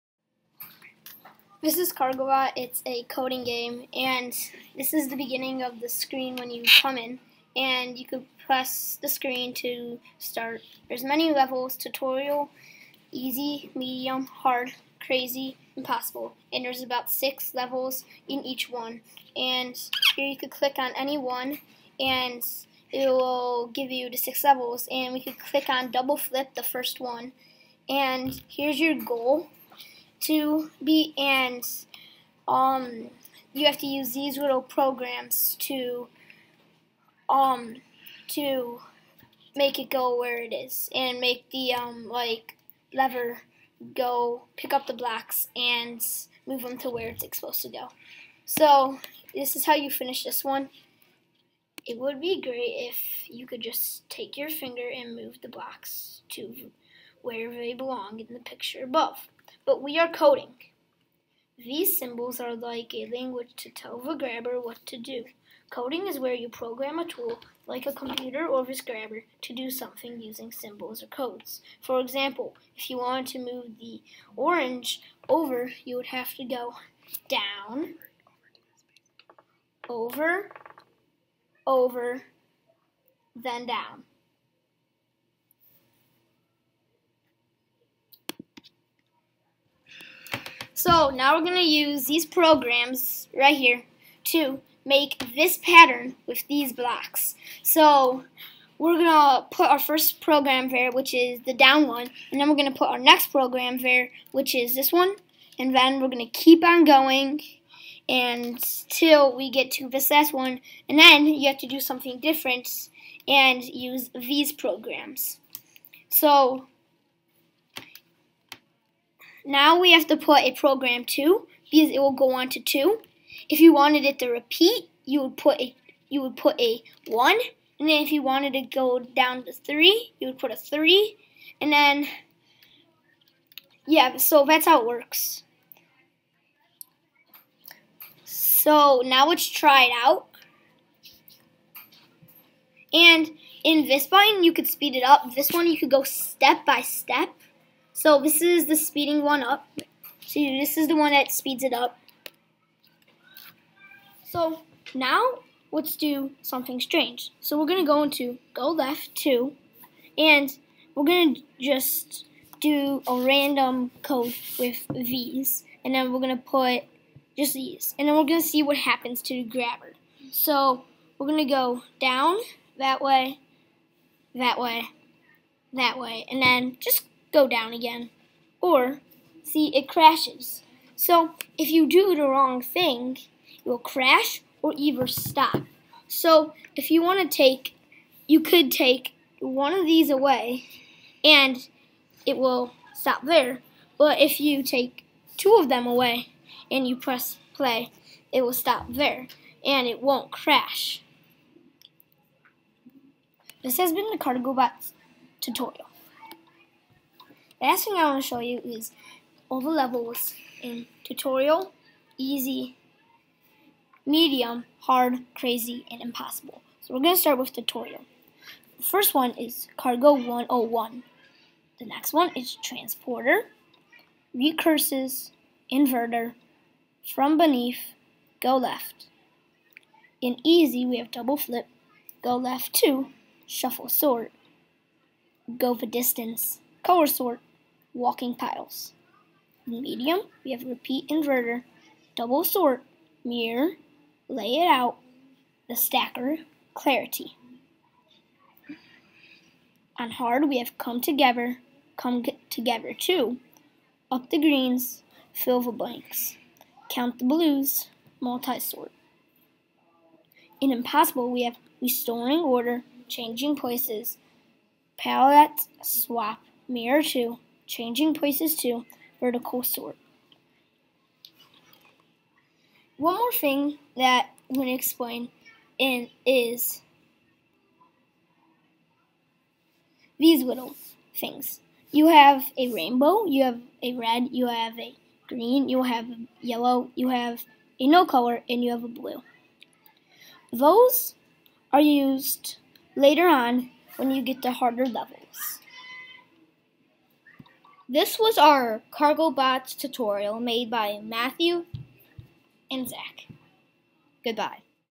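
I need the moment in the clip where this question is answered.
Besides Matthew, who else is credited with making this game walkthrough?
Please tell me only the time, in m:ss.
5:02.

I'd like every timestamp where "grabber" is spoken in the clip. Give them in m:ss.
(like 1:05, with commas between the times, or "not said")
1:04, 1:08, 2:49.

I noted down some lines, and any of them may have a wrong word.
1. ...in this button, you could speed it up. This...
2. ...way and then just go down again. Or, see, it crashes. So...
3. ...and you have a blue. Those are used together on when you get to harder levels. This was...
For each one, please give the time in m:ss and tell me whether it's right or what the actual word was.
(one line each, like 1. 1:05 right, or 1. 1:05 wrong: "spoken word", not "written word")
1. 2:23 right
2. 2:55 right
3. 4:48 wrong: "later", not "together".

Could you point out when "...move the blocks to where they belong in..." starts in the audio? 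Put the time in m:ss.
0:55.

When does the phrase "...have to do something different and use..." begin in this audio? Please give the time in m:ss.
1:51.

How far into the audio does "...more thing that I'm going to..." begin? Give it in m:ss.
4:33.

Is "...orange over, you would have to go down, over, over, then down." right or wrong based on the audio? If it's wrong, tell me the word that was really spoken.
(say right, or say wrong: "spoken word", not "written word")
right.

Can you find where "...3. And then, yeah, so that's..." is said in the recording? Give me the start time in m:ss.
2:10.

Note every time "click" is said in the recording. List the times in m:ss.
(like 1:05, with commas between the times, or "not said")
0:20, 0:25.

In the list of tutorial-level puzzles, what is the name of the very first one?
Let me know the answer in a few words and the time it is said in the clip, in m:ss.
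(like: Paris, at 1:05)
Cargo 101, at 3:39.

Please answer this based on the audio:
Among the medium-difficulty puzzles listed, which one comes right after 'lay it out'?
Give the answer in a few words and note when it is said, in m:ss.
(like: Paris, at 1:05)
The Stacker, at 4:05.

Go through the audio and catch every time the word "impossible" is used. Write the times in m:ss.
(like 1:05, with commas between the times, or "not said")
0:15, 3:36, 4:20.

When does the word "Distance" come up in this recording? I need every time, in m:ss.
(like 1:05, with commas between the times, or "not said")
3:55.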